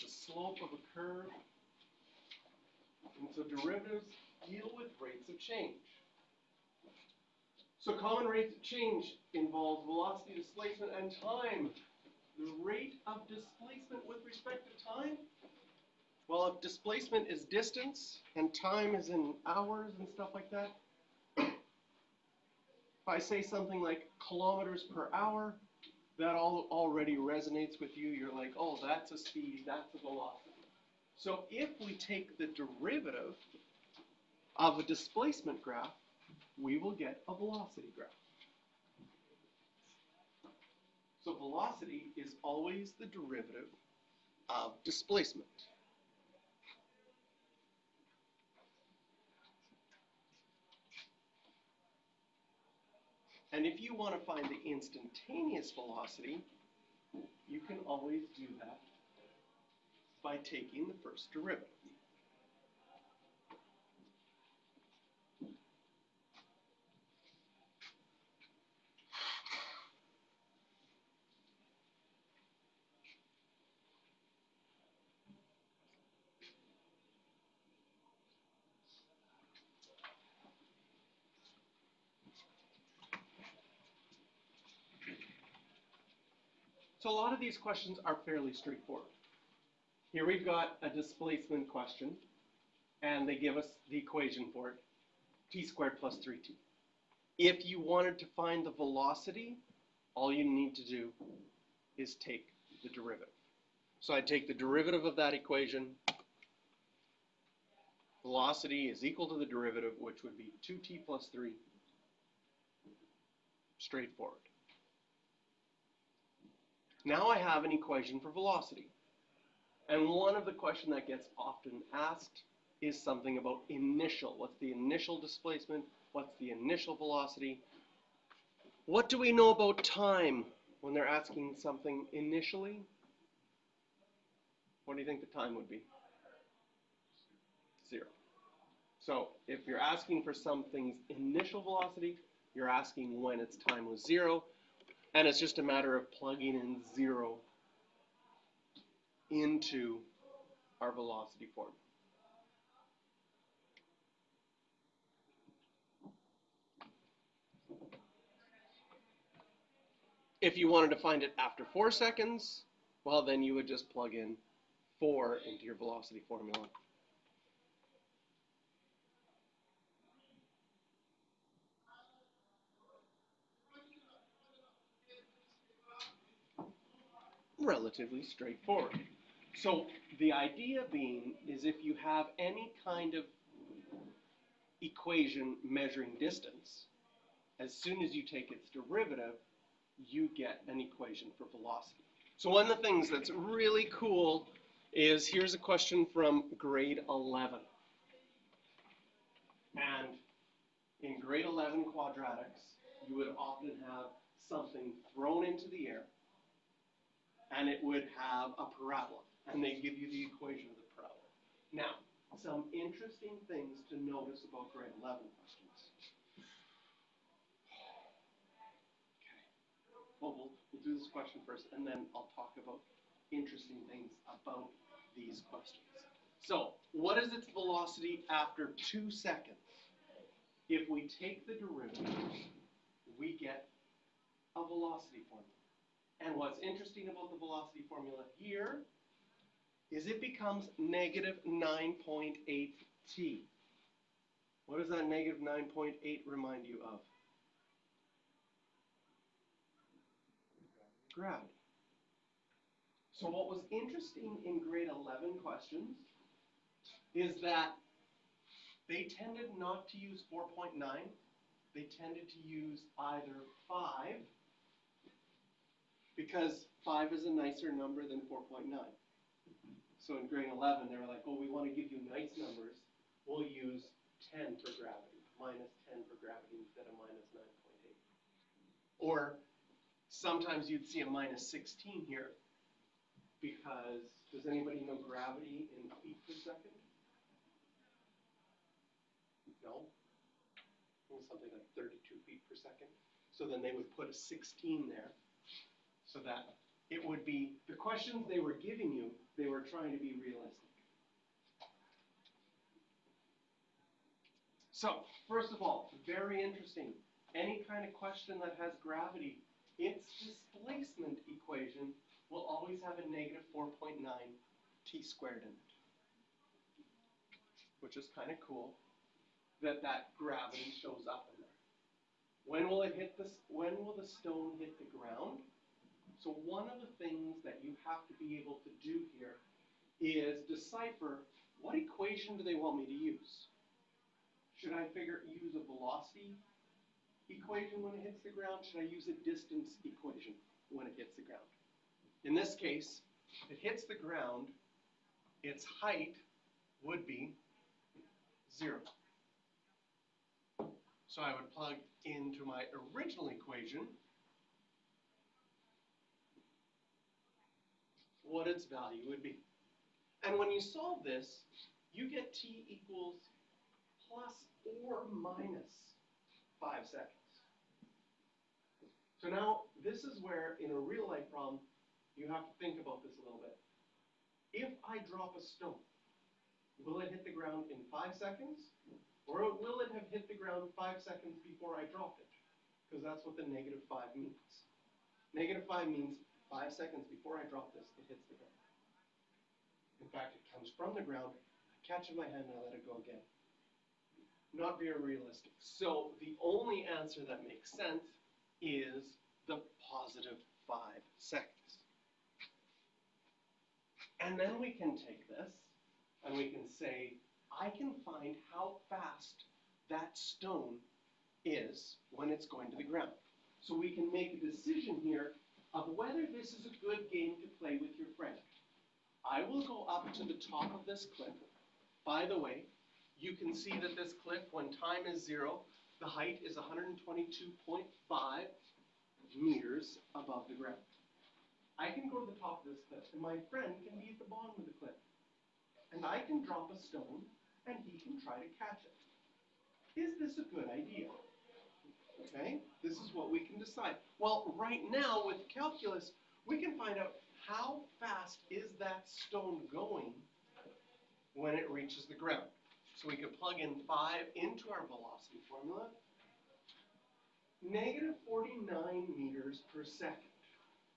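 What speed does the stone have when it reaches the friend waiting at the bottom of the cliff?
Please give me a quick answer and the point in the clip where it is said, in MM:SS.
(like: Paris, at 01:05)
-49 m/s, at 07:37.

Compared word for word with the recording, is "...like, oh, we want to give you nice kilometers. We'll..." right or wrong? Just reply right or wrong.
wrong.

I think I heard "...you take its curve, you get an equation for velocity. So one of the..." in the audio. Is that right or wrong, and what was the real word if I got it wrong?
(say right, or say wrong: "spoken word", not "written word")
wrong: "derivative", not "curve".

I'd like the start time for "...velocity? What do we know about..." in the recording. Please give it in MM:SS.
02:06.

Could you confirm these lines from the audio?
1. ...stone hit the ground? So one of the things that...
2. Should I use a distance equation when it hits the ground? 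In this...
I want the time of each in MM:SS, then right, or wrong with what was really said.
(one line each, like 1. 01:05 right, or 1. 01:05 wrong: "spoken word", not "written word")
1. 05:24 right
2. 05:38 right.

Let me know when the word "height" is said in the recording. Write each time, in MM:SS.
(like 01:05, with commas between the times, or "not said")
05:45, 07:06.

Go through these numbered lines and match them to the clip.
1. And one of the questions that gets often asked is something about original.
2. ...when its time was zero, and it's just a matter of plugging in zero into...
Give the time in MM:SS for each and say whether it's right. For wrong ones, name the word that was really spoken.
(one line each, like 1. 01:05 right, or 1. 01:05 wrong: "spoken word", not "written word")
1. 01:59 wrong: "initial", not "original"
2. 02:23 right.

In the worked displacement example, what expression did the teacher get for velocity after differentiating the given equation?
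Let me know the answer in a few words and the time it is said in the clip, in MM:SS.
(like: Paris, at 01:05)
2t + 3, at 01:50.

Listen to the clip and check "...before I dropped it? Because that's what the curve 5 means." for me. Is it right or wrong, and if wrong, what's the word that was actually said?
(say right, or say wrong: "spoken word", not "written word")
wrong: "negative", not "curve".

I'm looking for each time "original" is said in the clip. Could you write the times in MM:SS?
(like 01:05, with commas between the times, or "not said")
05:52.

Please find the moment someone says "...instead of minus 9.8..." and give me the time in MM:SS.
04:36.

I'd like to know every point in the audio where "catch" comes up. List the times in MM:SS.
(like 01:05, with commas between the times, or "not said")
06:31, 07:18.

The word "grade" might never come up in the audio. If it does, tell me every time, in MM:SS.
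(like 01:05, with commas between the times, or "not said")
03:16, 03:21, 03:34, 04:14, 04:30.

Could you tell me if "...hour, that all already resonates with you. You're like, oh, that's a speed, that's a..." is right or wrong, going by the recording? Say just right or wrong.
right.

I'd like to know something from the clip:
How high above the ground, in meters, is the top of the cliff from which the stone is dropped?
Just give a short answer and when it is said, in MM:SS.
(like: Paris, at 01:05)
122.5 meters, at 07:06.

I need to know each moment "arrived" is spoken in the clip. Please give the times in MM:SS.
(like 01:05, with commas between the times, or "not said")
not said.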